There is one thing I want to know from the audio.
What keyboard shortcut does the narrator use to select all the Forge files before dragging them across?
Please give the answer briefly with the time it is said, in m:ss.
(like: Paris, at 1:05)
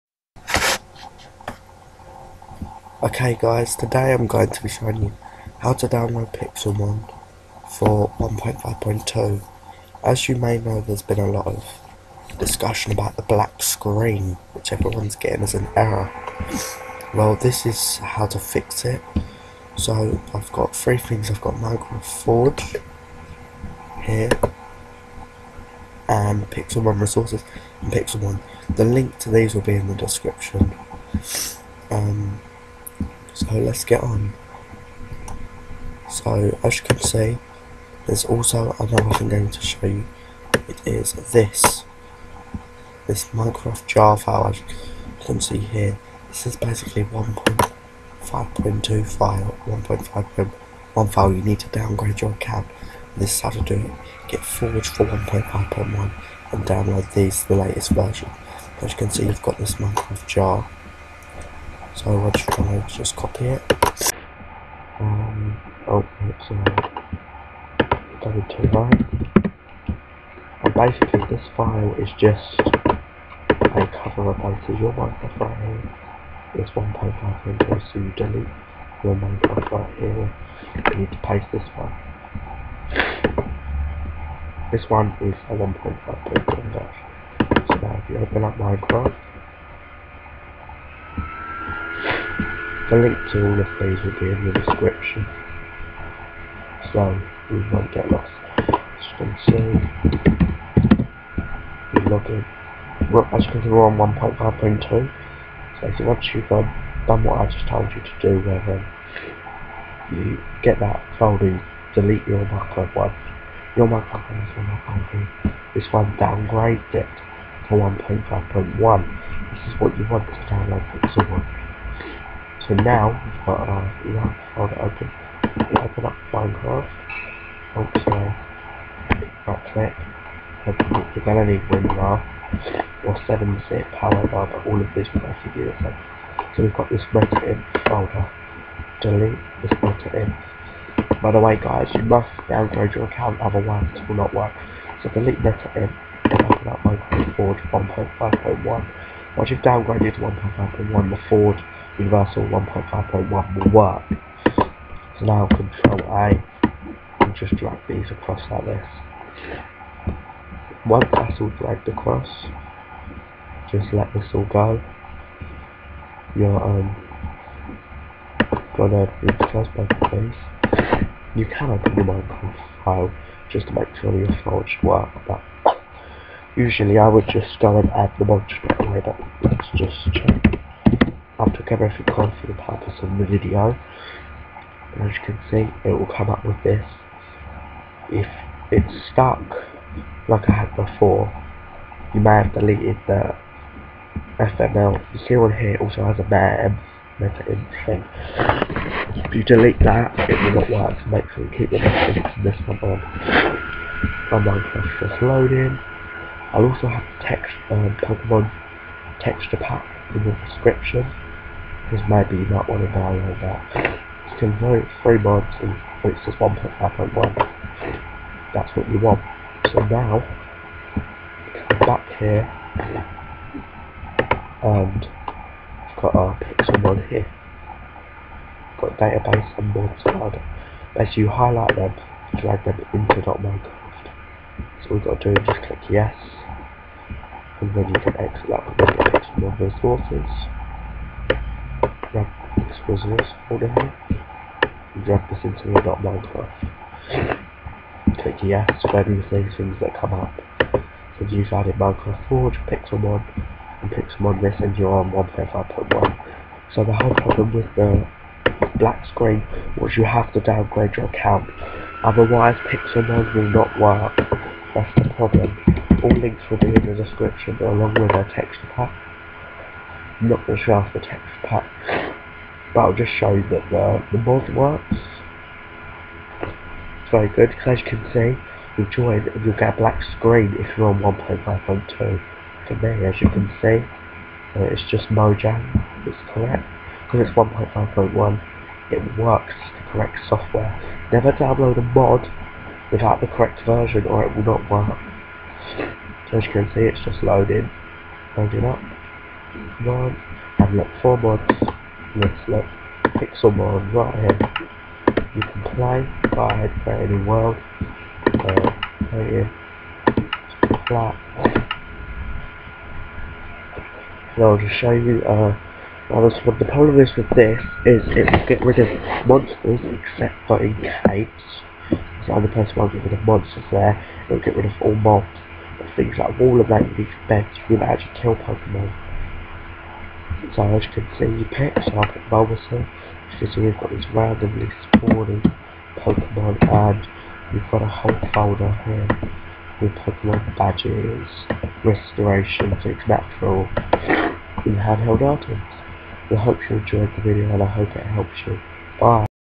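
Control A, at 2:35.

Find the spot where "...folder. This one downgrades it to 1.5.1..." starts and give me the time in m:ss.
1:54.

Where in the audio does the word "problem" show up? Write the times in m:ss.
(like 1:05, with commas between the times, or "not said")
4:17, 4:25, 5:16.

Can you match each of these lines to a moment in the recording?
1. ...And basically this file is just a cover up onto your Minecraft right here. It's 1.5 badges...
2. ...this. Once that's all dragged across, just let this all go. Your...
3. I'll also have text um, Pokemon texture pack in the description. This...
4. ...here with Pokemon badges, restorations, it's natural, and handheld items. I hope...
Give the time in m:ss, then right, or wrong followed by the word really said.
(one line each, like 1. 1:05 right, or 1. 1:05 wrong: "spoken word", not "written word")
1. 1:10 wrong: "inches", not "badges"
2. 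2:38 right
3. 3:26 right
4. 5:38 right.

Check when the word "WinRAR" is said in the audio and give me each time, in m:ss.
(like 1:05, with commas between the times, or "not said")
2:11.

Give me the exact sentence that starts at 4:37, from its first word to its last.
It's very good, because as you can see, you join and you'll get a black screen if you're on 1.5.2.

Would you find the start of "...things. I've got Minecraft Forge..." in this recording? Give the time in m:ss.
0:20.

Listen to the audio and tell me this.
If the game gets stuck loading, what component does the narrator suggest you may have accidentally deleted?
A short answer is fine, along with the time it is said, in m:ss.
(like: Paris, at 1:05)
FML, at 3:14.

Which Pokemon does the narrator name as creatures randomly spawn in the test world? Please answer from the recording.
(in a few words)
Bulbasaur.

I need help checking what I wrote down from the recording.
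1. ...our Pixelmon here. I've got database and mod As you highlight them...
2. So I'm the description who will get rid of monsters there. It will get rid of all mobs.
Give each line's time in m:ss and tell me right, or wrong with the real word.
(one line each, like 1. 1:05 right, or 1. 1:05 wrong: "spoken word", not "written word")
1. 3:46 right
2. 5:22 wrong: "person", not "description".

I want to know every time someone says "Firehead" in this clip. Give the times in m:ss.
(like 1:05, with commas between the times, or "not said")
5:06.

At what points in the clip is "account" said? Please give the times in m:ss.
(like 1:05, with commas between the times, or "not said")
0:52, 2:23, 4:21.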